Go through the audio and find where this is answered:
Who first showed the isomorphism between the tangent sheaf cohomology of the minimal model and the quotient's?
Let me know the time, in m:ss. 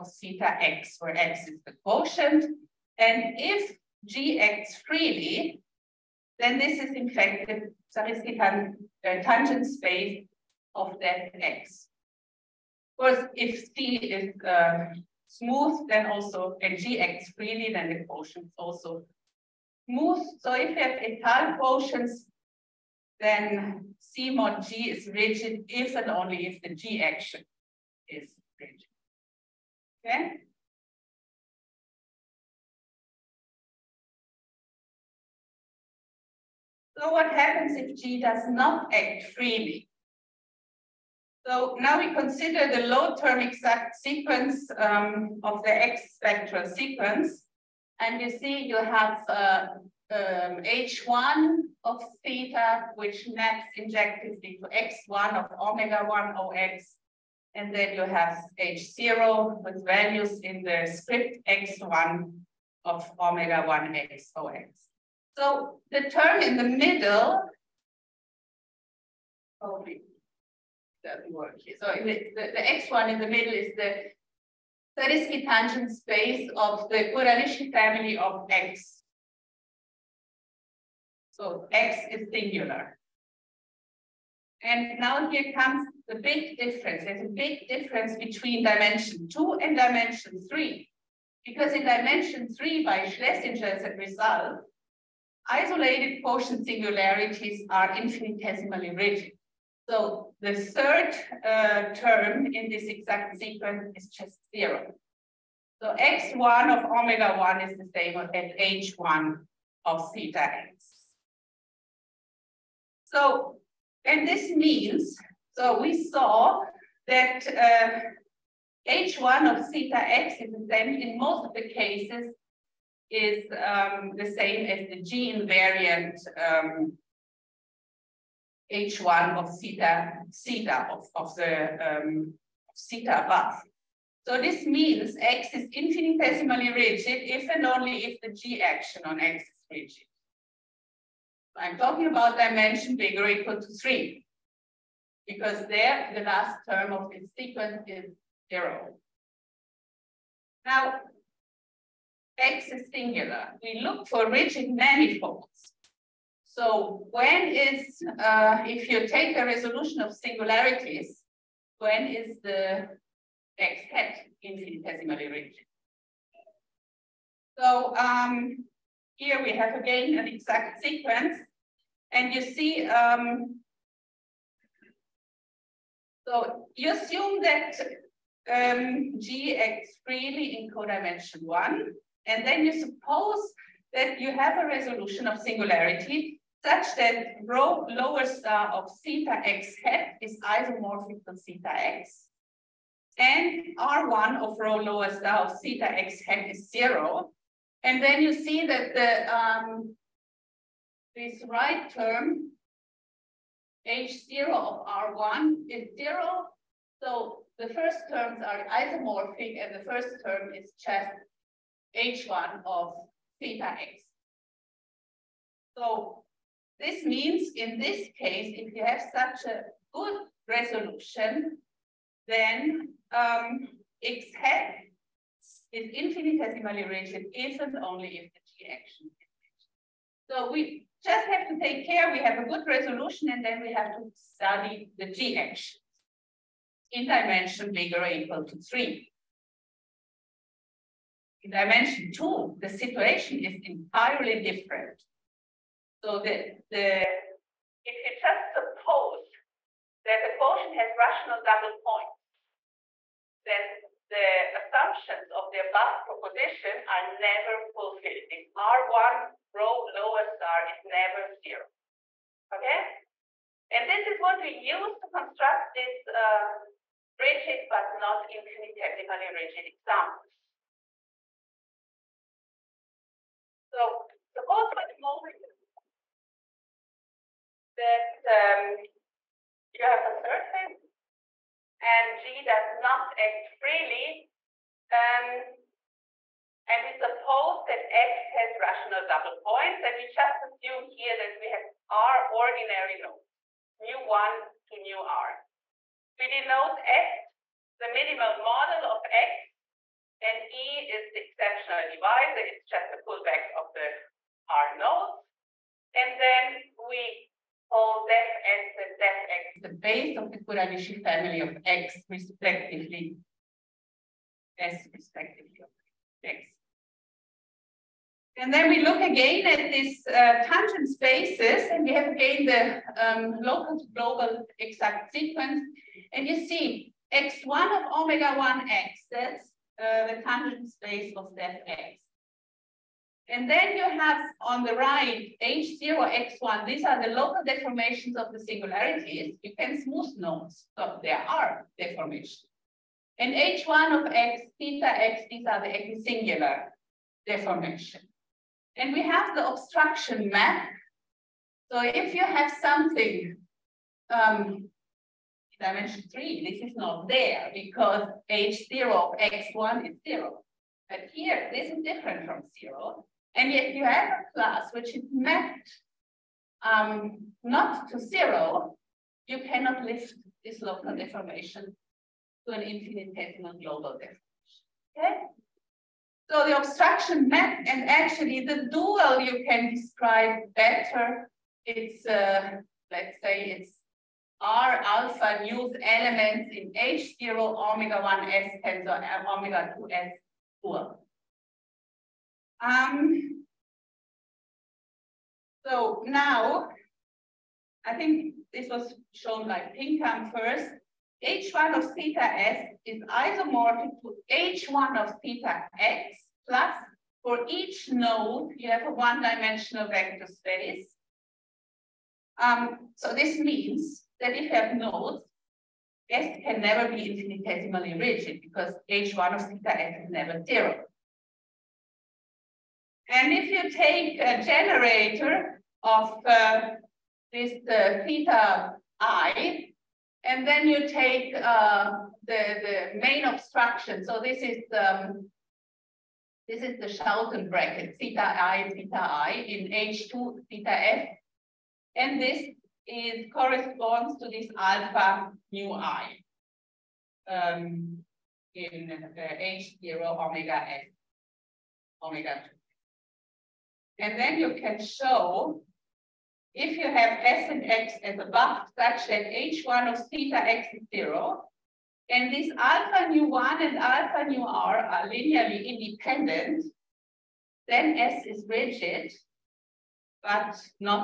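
6:39.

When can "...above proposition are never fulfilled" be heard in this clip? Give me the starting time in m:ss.
4:15.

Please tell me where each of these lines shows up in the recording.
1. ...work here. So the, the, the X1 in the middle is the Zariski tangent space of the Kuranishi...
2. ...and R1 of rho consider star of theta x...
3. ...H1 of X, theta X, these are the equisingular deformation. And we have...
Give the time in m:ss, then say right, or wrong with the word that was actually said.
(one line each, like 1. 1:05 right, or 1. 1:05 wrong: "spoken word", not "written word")
1. 1:11 right
2. 3:13 wrong: "lower", not "consider"
3. 5:43 right.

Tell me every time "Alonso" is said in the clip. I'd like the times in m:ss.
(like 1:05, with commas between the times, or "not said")
not said.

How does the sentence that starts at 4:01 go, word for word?
In dimension two, the situation is entirely different.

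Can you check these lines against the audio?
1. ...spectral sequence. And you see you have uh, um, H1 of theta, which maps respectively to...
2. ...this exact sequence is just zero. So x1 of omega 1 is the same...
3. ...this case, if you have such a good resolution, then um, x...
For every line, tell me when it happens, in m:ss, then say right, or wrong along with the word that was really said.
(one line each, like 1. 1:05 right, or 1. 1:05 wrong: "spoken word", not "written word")
1. 0:46 wrong: "injectively", not "respectively"
2. 1:42 right
3. 3:37 right.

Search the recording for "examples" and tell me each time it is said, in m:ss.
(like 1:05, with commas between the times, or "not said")
4:29.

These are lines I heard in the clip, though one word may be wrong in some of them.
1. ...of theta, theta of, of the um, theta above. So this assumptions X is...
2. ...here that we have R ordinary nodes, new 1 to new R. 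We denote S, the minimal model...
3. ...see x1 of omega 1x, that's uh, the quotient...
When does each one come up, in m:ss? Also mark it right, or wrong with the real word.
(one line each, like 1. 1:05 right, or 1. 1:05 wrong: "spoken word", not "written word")
1. 2:09 wrong: "means", not "assumptions"
2. 4:50 right
3. 5:26 wrong: "tangent", not "quotient".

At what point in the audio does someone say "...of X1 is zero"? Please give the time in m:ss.
5:58.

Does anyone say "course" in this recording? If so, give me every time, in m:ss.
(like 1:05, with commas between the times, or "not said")
0:13.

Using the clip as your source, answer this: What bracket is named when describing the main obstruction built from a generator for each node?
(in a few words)
Schouten bracket.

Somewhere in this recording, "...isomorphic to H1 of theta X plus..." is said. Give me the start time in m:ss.
6:43.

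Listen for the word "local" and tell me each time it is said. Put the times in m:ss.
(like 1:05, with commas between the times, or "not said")
5:23, 5:37, 6:10.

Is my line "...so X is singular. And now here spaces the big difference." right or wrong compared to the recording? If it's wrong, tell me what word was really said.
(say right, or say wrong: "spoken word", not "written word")
wrong: "comes", not "spaces".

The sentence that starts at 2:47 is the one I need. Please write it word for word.
So um, here we have again an exact sequence.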